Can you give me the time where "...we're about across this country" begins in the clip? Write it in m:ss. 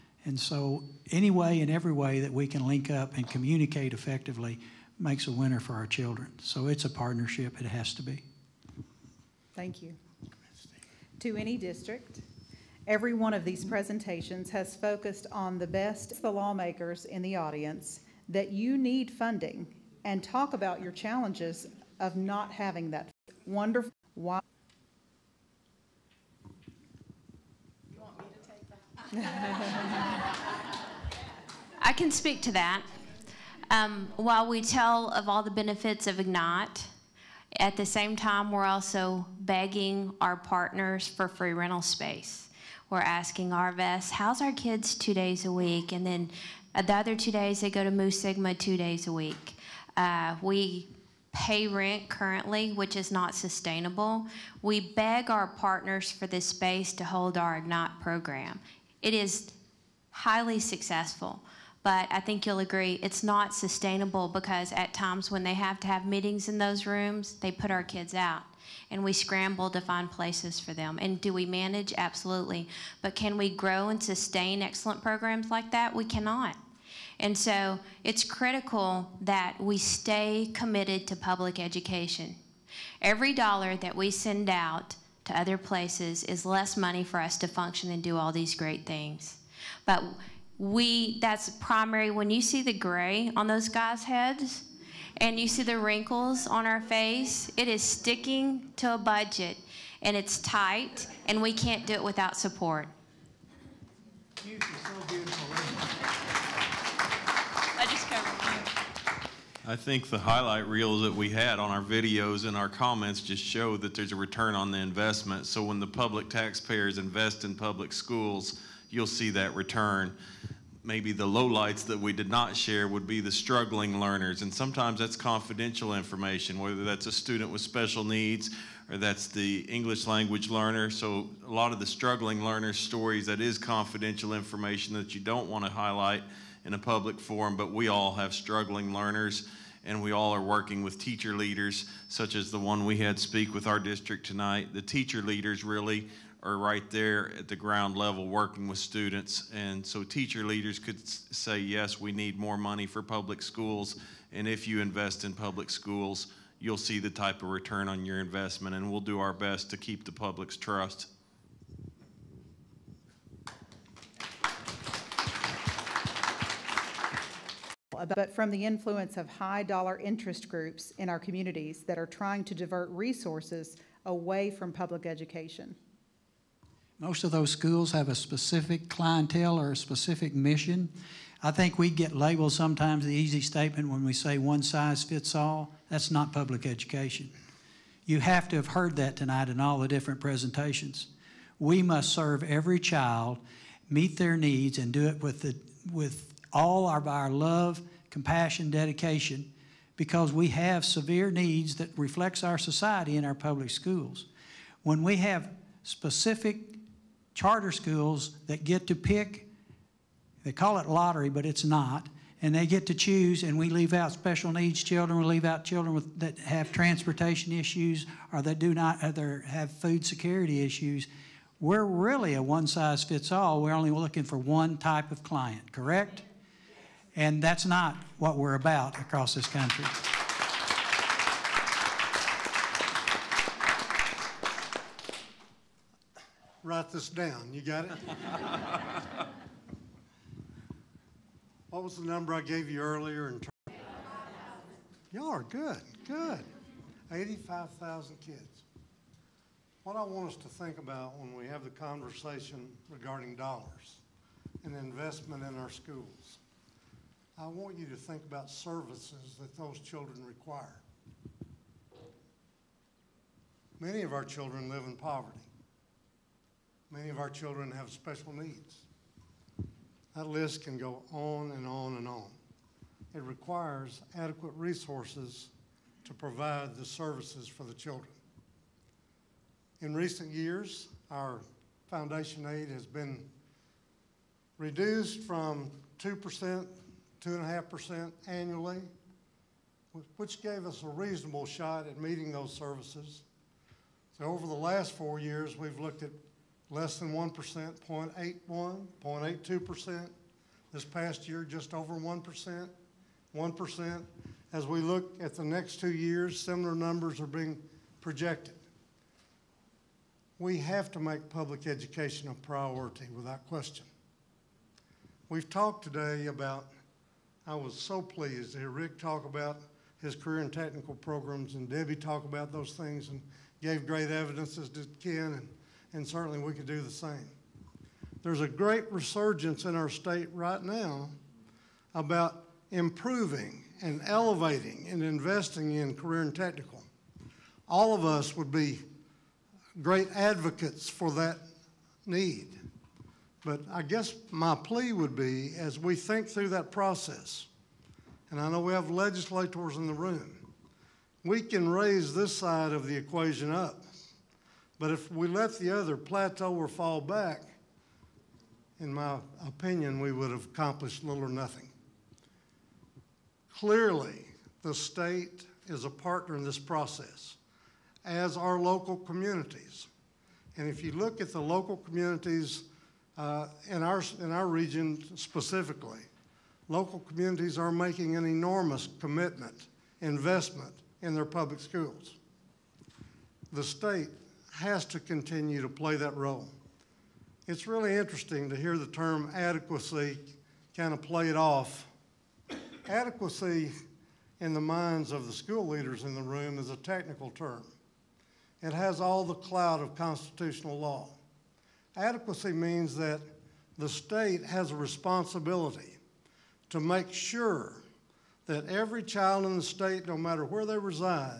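3:48.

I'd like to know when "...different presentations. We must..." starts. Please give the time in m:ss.
3:09.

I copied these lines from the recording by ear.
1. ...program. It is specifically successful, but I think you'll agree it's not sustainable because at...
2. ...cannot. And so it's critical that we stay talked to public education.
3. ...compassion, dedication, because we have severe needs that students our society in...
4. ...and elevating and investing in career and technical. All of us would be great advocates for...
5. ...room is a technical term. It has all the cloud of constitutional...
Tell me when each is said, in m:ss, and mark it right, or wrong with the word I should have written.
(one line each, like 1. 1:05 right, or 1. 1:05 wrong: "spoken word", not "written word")
1. 0:58 wrong: "highly", not "specifically"
2. 1:16 wrong: "committed", not "talked"
3. 3:18 wrong: "reflects", not "students"
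4. 5:33 right
5. 6:36 right.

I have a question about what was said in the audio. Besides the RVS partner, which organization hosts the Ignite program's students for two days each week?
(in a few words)
Mu Sigma.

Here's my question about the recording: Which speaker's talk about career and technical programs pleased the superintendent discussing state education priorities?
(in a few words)
Rick.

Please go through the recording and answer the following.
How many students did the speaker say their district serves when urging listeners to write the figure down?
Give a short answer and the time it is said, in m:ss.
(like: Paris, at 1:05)
85,000, at 4:07.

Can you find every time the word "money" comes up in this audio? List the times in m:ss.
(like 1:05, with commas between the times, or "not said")
1:26, 2:32.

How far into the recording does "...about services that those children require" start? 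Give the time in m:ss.
4:18.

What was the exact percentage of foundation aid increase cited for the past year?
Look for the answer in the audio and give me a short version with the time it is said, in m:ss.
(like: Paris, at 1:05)
0.82%, at 4:59.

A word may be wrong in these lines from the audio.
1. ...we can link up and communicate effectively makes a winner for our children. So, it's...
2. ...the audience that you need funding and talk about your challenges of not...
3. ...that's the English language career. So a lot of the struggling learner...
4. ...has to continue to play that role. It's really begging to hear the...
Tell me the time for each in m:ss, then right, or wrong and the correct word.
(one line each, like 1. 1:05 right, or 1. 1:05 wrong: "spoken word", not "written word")
1. 0:02 right
2. 0:17 right
3. 2:08 wrong: "learner", not "career"
4. 6:24 wrong: "interesting", not "begging".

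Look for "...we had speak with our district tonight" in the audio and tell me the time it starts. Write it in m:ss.
2:22.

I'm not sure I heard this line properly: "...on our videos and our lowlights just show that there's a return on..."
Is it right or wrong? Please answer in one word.
wrong.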